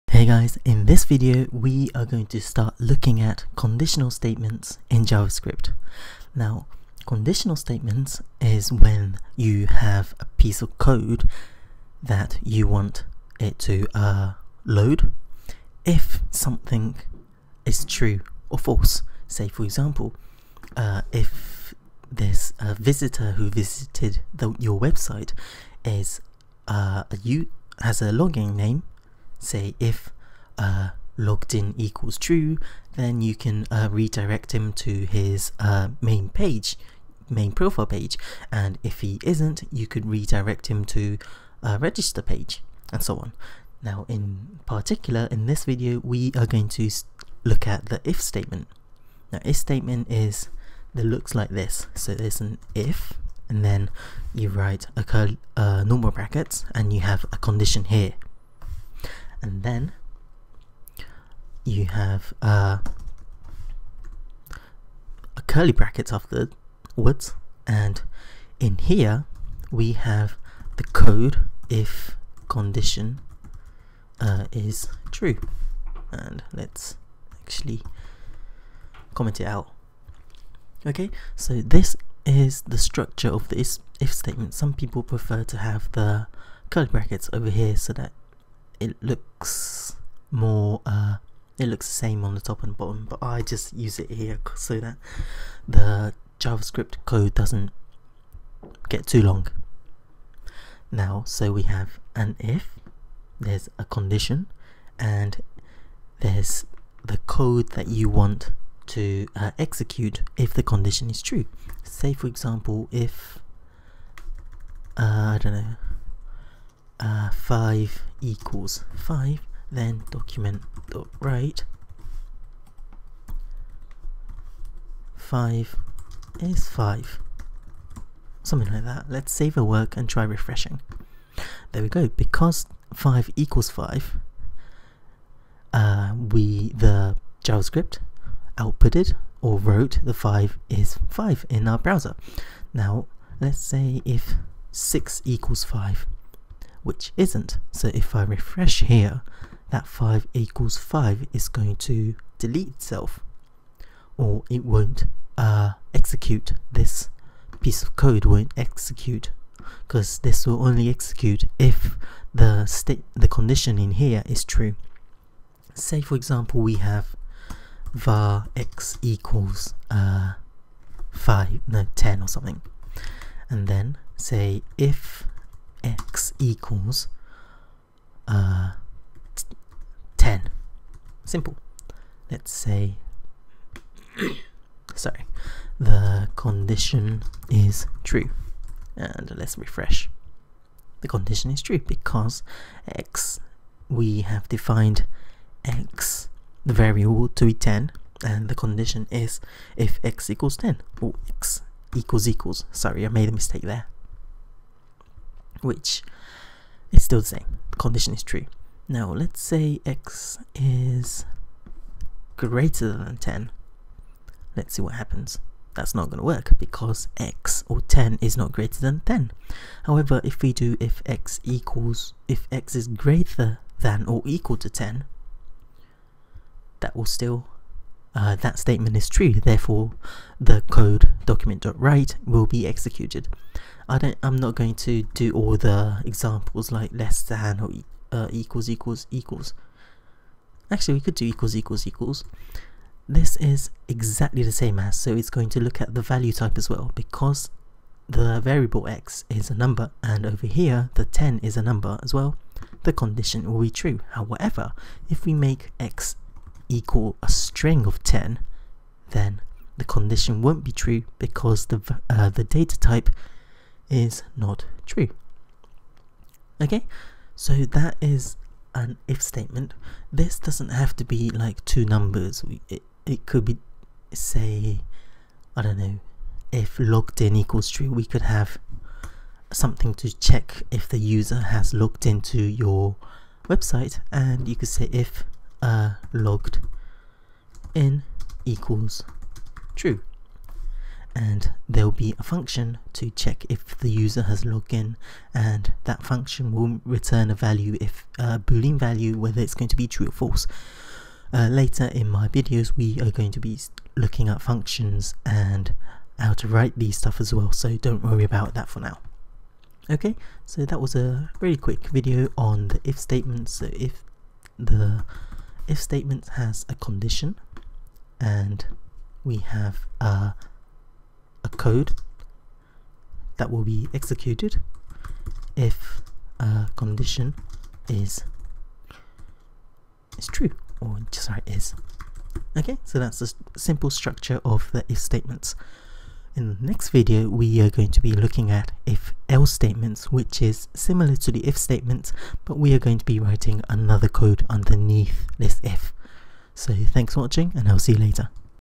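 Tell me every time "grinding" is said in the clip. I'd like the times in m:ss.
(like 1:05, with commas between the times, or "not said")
not said.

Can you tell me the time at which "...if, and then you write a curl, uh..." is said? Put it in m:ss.
0:52.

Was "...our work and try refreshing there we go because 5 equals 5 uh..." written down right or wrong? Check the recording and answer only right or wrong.
right.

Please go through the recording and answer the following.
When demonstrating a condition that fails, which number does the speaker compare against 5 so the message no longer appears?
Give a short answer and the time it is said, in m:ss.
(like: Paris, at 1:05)
6, at 2:24.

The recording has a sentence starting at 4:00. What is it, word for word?
Actually, we could do equals equals equals.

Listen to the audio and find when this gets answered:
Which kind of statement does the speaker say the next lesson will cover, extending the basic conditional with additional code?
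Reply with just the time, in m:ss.
5:38.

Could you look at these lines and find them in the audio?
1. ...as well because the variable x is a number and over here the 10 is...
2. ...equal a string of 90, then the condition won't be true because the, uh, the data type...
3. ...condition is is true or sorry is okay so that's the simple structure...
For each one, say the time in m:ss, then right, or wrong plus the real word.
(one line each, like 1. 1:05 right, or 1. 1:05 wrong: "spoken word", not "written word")
1. 4:06 right
2. 4:16 wrong: "10", not "90"
3. 5:26 right.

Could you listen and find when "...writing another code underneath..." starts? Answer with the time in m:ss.
5:43.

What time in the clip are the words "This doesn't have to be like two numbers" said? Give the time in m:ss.
4:30.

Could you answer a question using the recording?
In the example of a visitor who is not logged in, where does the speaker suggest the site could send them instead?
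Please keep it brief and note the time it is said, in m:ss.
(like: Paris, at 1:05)
register page, at 0:41.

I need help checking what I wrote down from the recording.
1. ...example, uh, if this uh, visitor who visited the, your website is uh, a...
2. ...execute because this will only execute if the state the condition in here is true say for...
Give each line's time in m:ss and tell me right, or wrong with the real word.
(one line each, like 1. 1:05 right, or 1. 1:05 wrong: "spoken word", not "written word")
1. 0:19 right
2. 2:38 right.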